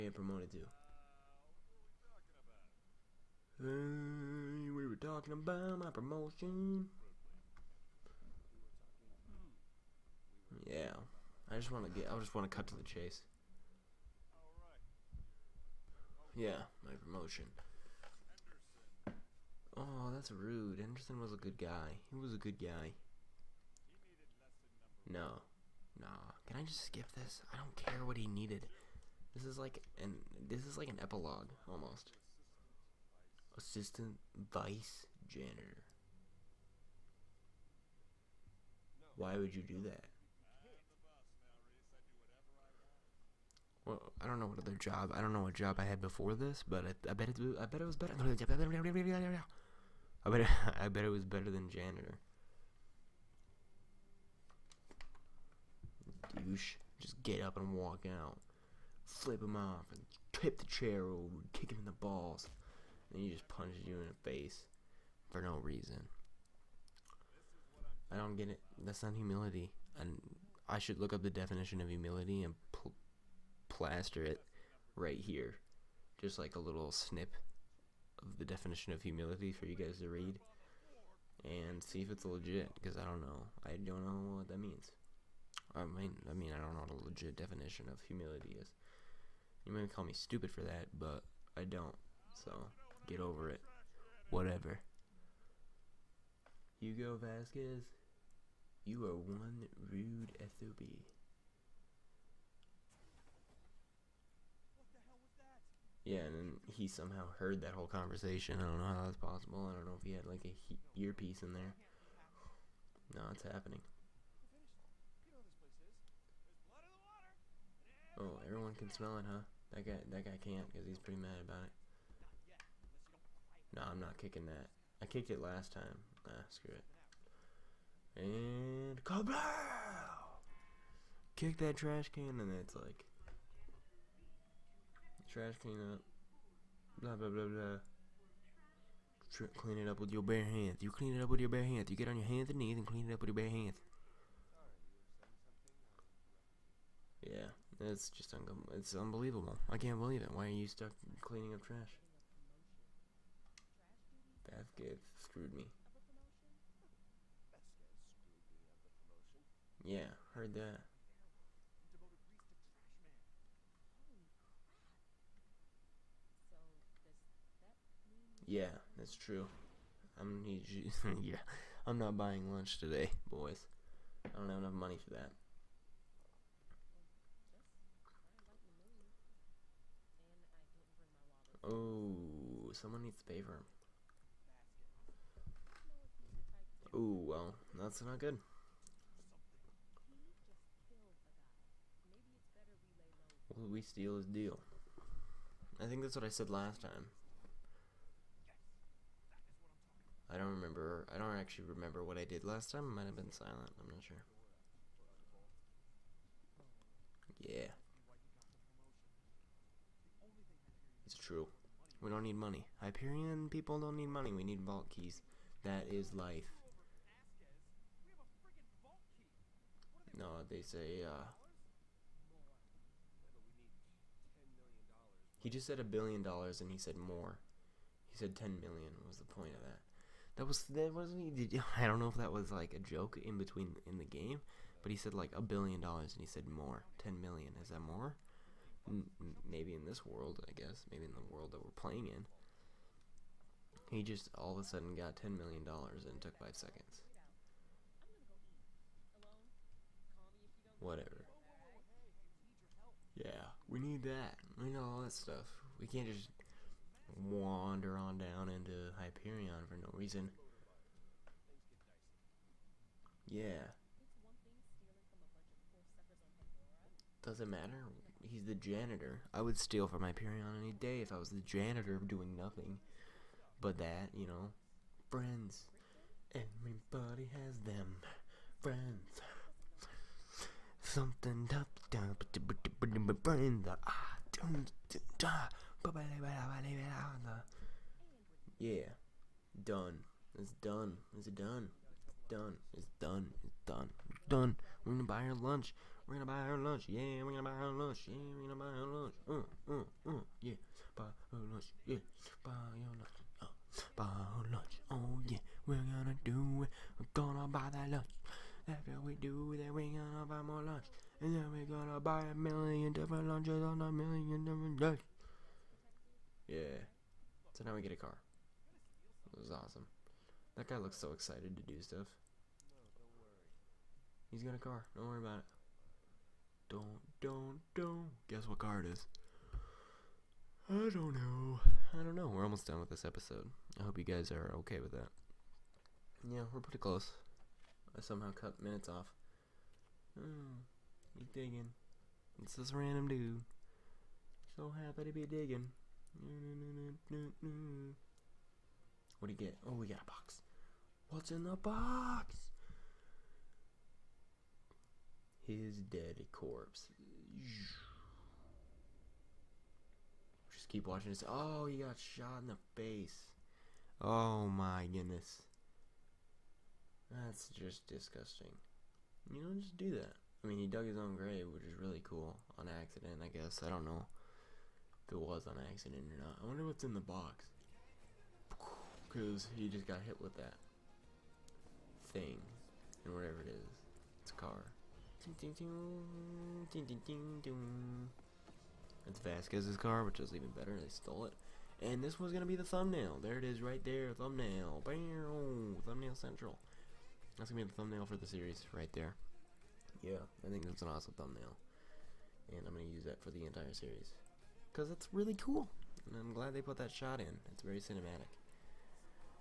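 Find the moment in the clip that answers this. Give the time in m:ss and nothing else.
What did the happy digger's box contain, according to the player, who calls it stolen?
6:29.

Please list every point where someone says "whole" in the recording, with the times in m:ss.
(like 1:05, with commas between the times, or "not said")
1:47.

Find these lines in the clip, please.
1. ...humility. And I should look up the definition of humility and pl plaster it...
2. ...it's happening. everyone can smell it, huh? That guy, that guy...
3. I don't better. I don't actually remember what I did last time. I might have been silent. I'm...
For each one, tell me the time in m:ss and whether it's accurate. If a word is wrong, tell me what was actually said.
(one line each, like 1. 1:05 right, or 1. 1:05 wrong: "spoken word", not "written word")
1. 1:09 right
2. 1:53 right
3. 3:20 wrong: "remember", not "better".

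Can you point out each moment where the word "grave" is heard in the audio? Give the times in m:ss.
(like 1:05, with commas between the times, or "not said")
6:11.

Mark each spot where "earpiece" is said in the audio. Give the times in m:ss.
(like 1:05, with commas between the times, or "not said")
1:51.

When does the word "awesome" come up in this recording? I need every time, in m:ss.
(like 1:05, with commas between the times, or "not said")
5:19, 6:40.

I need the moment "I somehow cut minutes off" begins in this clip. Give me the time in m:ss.
5:37.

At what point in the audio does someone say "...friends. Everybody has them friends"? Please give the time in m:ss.
4:35.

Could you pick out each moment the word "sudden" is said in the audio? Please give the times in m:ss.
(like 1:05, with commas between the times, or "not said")
4:04.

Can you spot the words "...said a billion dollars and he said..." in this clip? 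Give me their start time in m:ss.
3:45.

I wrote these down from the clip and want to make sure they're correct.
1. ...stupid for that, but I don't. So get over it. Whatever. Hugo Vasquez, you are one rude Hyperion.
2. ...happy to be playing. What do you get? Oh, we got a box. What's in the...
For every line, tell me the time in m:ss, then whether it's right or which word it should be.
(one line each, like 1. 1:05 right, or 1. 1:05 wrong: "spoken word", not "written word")
1. 1:30 wrong: "SOB", not "Hyperion"
2. 5:44 wrong: "digging", not "playing".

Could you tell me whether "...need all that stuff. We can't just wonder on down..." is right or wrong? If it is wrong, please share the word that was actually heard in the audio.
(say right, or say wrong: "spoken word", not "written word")
wrong: "wander", not "wonder".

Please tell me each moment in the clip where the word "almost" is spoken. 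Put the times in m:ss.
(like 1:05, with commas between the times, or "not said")
0:31, 5:32.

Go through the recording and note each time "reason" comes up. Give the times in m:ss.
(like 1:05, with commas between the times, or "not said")
1:05, 4:19.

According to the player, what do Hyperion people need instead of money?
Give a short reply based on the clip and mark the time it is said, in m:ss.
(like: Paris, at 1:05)
Vault keys, at 3:34.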